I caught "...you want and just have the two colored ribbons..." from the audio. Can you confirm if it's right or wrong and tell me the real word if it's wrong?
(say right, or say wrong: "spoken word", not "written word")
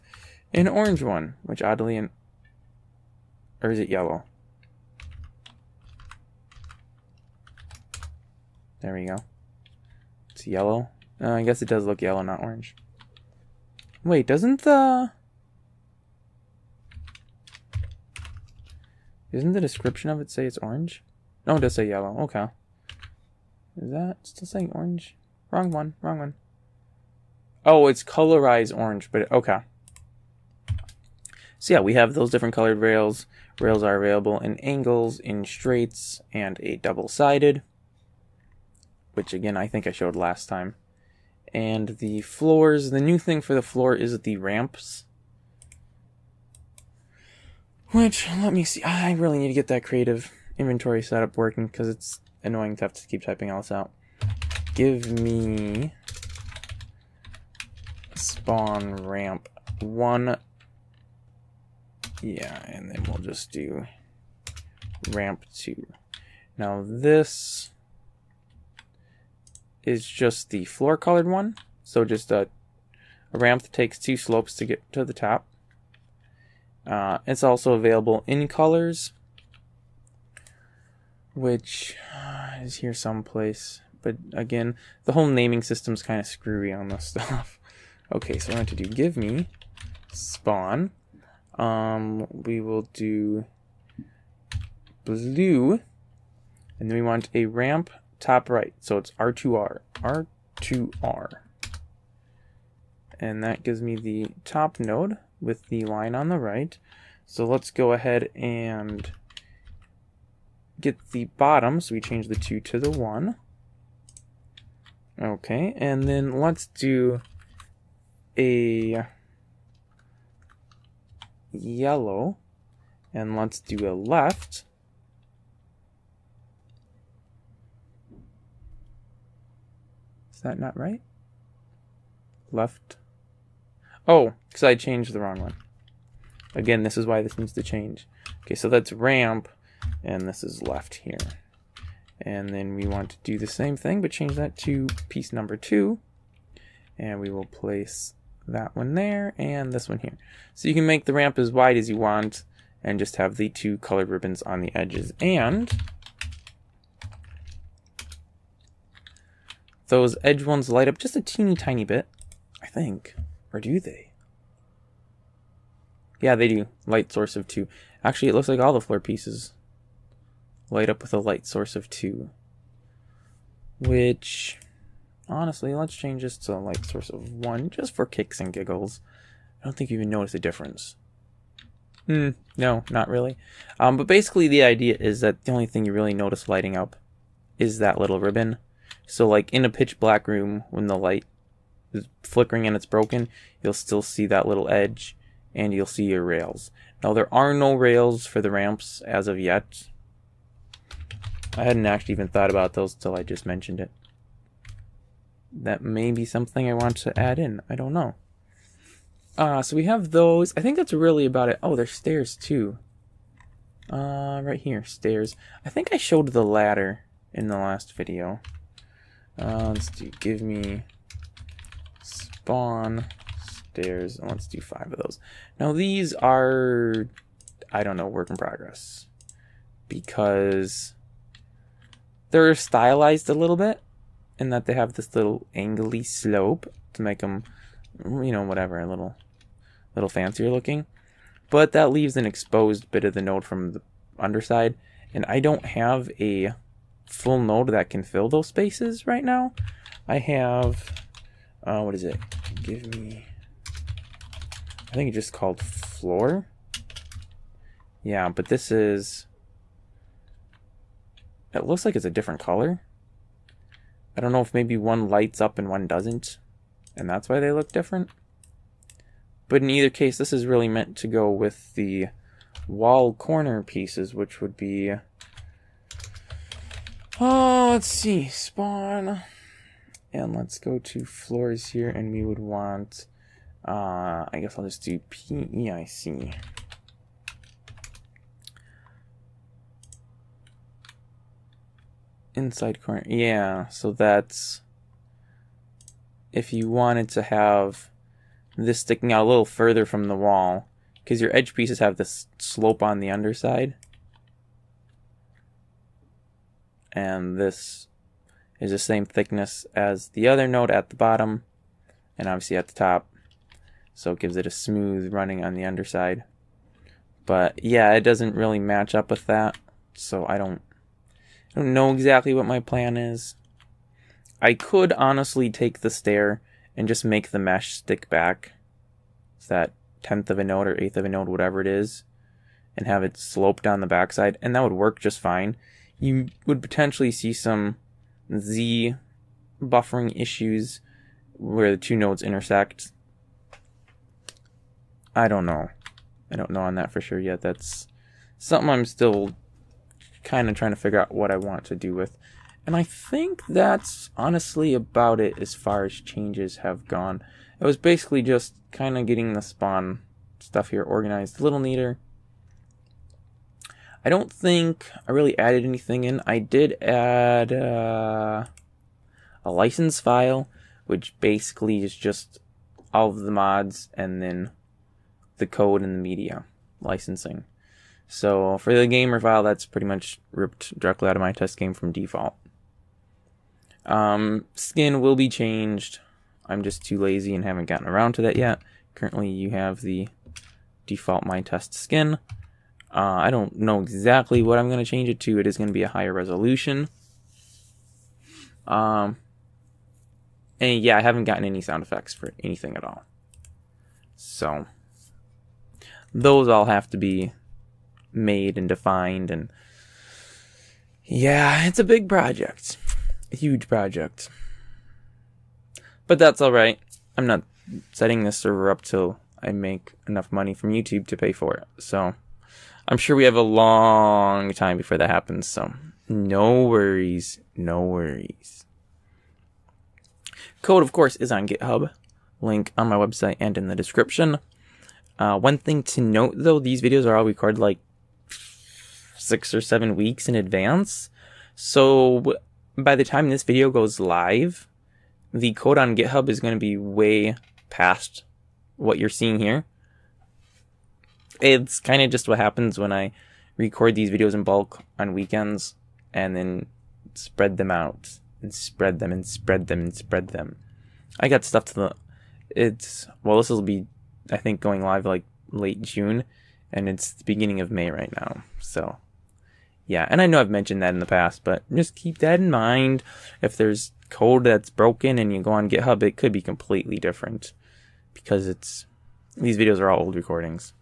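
right.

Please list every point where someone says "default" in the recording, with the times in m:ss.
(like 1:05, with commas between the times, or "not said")
6:21, 6:30.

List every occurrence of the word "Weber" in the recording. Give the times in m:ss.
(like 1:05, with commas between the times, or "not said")
not said.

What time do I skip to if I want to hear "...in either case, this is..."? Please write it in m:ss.
4:29.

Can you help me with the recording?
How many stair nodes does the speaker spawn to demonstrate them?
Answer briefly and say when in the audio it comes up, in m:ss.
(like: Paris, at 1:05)
5, at 3:44.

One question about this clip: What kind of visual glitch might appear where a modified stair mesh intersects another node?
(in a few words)
Z buffering.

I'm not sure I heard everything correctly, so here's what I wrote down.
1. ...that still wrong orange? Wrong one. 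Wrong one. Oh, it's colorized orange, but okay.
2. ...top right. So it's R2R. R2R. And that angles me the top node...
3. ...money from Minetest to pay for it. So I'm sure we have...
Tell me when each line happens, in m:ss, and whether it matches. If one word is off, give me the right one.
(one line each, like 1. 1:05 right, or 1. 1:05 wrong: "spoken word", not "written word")
1. 0:23 wrong: "saying", not "wrong"
2. 1:38 wrong: "gives", not "angles"
3. 7:00 wrong: "YouTube", not "Minetest".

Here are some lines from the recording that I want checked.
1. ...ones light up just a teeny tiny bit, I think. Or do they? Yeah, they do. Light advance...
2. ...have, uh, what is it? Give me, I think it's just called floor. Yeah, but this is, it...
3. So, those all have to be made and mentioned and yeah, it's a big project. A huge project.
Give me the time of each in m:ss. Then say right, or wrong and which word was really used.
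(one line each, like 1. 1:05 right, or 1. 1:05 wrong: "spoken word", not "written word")
1. 2:40 wrong: "source", not "advance"
2. 4:10 right
3. 6:44 wrong: "defined", not "mentioned".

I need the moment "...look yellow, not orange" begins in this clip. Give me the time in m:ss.
0:11.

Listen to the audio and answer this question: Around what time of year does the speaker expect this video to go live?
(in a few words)
Late June.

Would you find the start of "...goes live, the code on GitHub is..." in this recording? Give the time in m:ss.
7:23.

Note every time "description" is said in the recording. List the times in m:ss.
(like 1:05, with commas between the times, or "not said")
0:19, 7:13.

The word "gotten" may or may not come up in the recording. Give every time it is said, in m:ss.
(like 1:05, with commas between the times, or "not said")
6:27, 6:41.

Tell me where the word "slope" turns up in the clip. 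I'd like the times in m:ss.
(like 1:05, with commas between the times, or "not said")
1:14, 3:56, 5:02, 5:33.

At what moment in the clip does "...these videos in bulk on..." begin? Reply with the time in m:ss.
7:33.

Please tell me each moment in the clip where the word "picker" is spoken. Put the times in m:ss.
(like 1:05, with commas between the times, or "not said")
not said.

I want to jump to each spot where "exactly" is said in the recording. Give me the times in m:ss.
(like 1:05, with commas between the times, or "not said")
5:21, 6:33.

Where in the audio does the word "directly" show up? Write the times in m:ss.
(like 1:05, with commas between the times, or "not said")
6:20.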